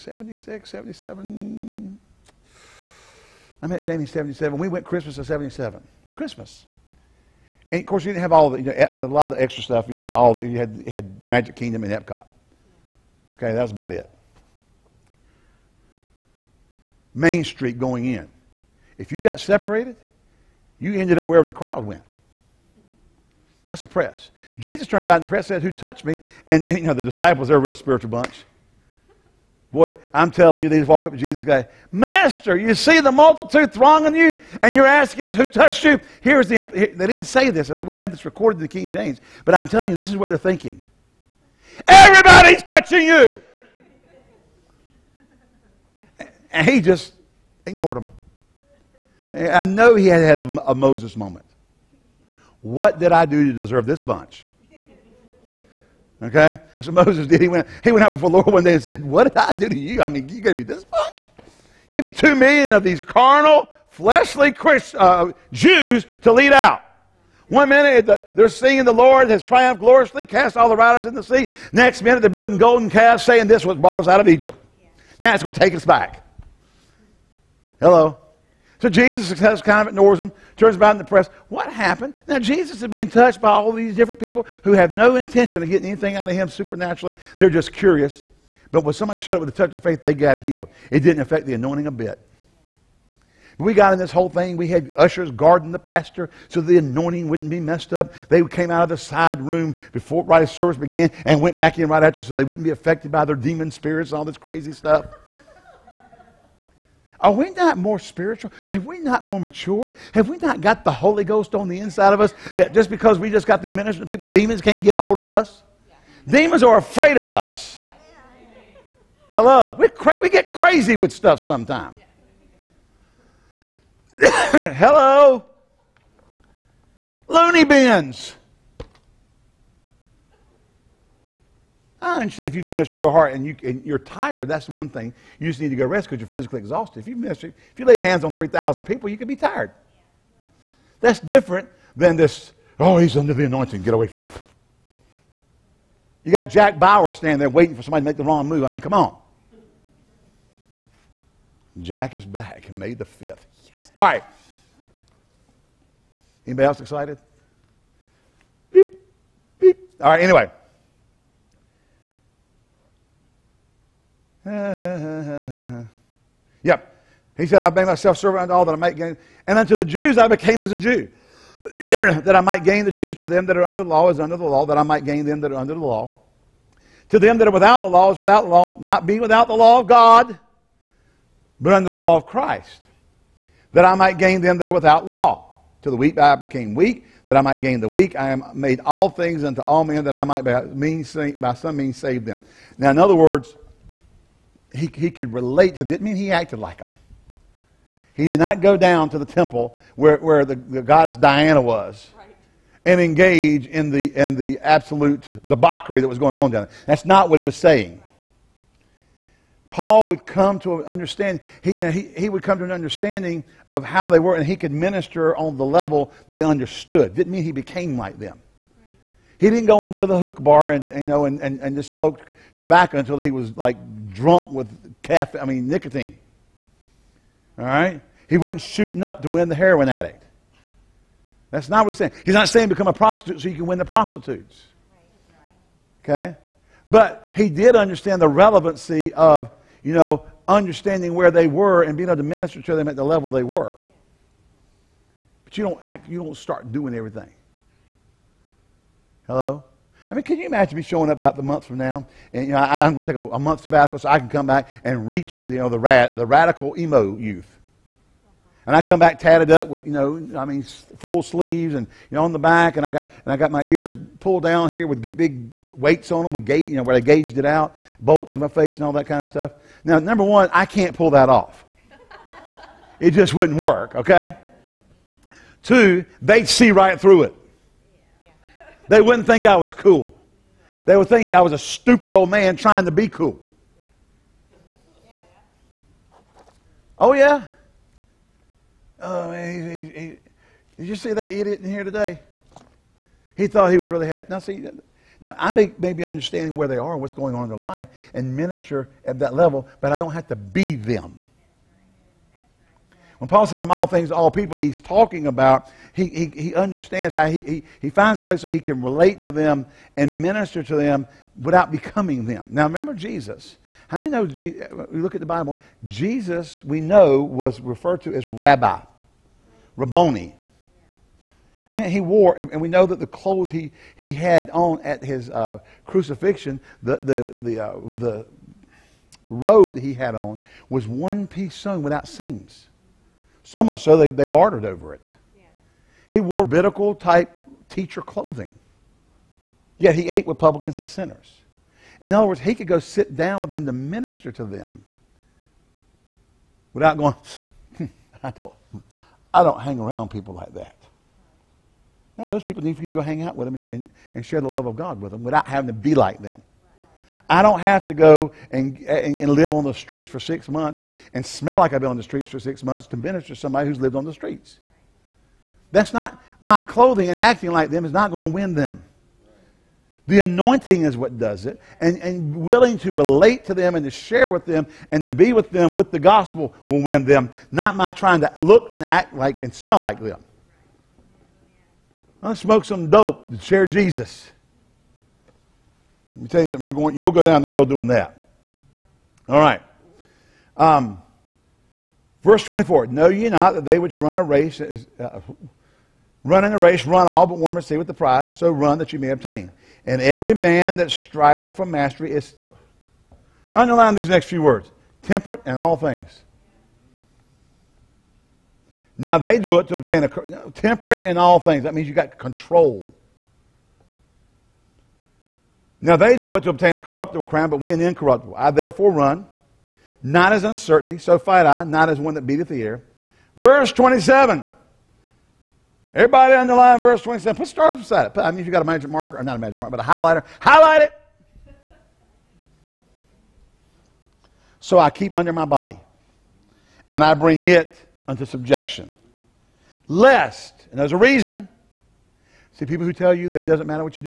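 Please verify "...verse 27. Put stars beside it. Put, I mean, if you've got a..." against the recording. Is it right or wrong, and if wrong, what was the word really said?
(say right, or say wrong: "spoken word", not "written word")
right.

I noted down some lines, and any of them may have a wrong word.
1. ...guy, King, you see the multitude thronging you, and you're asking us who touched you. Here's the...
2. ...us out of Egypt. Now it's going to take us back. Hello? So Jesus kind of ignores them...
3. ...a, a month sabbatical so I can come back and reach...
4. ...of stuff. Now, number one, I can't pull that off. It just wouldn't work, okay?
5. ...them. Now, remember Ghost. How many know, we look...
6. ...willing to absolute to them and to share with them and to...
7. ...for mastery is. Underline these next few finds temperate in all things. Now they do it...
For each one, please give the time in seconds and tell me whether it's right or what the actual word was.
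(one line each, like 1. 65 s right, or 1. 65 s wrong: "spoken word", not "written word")
1. 31 s wrong: "Master", not "King"
2. 73 s right
3. 253 s right
4. 269 s right
5. 312 s wrong: "Jesus", not "Ghost"
6. 372 s wrong: "relate", not "absolute"
7. 401 s wrong: "words", not "finds".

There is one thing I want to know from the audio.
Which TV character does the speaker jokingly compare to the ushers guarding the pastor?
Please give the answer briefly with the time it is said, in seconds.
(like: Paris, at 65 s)
Jack Bauer, at 146 s.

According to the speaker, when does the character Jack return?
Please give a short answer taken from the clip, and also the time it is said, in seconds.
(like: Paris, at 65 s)
May 5, at 152 s.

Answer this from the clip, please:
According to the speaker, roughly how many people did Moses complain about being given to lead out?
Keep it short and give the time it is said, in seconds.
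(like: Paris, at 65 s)
2 million, at 62 s.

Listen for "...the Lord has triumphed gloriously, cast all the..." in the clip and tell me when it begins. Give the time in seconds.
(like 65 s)
68 s.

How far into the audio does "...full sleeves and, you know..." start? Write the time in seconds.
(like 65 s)
260 s.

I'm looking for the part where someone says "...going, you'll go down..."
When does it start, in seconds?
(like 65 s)
386 s.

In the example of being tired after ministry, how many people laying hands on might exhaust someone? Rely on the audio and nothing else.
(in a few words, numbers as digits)
3,000.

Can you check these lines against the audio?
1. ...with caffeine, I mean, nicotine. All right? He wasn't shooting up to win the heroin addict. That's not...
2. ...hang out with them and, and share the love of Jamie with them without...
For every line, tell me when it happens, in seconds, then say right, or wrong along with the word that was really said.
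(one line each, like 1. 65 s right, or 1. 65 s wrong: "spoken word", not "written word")
1. 224 s right
2. 352 s wrong: "God", not "Jamie".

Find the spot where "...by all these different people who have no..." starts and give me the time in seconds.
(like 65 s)
83 s.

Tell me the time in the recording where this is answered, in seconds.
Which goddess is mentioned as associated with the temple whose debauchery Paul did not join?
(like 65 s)
201 s.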